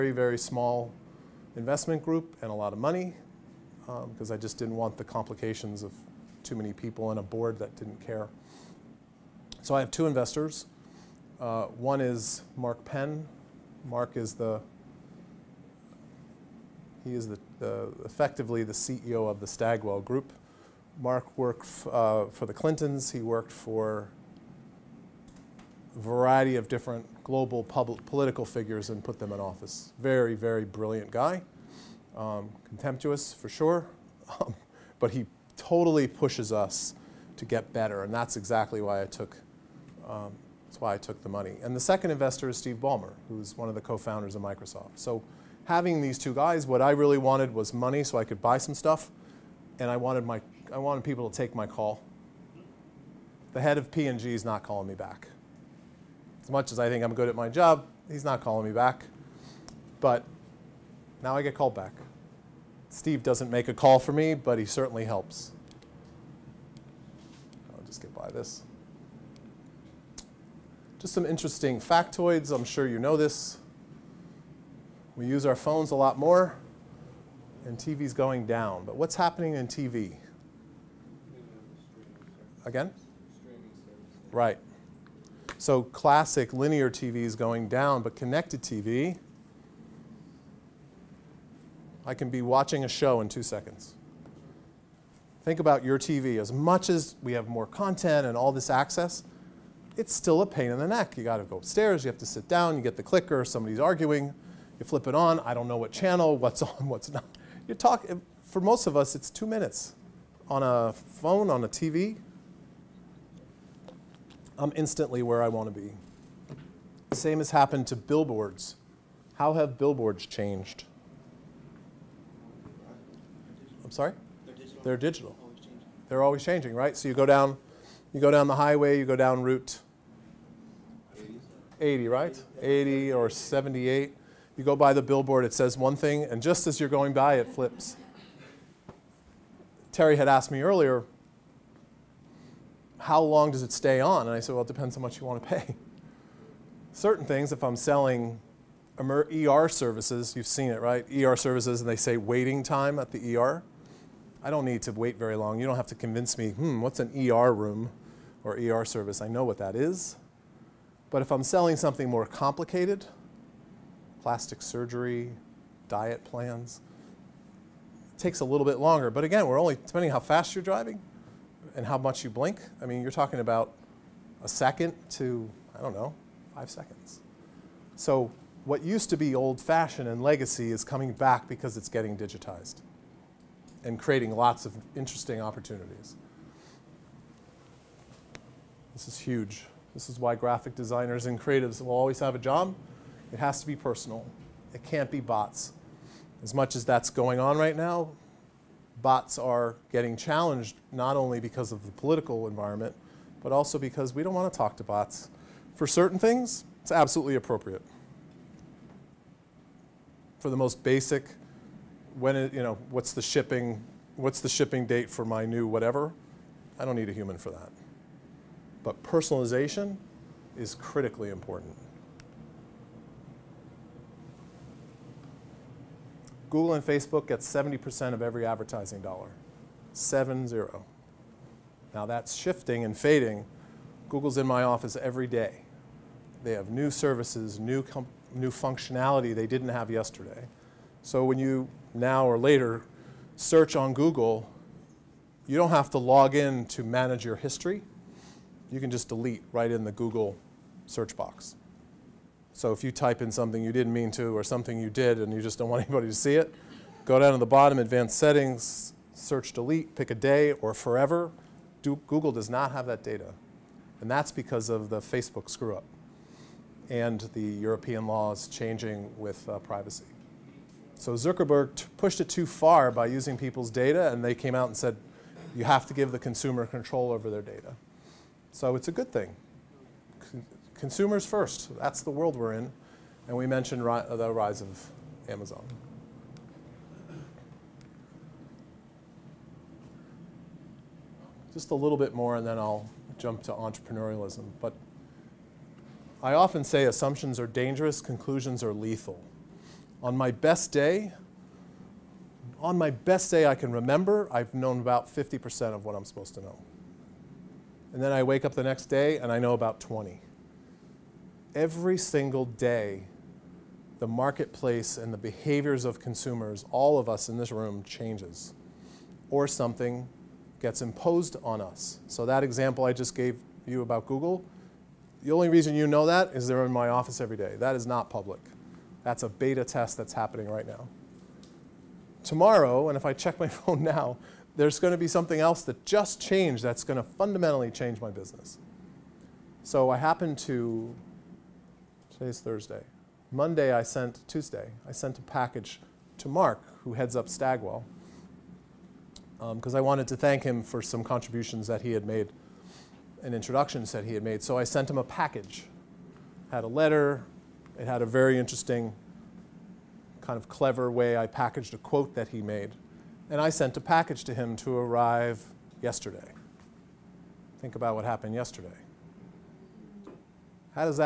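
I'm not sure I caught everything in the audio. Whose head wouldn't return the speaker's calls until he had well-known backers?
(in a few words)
P&G.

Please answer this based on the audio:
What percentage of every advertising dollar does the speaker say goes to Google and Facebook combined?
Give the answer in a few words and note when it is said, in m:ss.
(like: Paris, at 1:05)
70%, at 3:47.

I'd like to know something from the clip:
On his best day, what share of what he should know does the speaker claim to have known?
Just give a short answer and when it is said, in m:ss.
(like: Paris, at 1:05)
50%, at 5:05.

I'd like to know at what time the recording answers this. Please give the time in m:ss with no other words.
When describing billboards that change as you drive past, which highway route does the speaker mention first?
2:09.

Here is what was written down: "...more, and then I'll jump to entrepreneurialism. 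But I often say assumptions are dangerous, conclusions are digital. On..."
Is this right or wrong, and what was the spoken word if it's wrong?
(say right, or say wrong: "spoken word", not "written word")
wrong: "lethal", not "digital".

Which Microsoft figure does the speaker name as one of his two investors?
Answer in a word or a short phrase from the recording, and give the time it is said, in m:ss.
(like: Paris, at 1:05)
Steve Ballmer, at 0:42.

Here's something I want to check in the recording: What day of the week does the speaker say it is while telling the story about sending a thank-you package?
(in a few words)
Thursday.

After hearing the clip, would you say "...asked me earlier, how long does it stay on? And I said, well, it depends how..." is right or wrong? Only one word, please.
right.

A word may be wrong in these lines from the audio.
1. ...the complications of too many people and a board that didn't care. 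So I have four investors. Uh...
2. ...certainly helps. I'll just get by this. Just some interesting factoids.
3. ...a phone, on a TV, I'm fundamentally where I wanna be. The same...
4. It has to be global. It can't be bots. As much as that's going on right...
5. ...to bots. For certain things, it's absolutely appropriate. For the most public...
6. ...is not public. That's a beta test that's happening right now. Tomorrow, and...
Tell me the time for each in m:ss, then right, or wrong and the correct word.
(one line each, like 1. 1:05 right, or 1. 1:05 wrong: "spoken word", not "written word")
1. 0:04 wrong: "two", not "four"
2. 1:04 right
3. 1:50 wrong: "instantly", not "fundamentally"
4. 3:13 wrong: "personal", not "global"
5. 3:24 wrong: "basic", not "public"
6. 5:27 right.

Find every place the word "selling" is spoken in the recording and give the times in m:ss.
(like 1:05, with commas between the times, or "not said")
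2:27, 2:41.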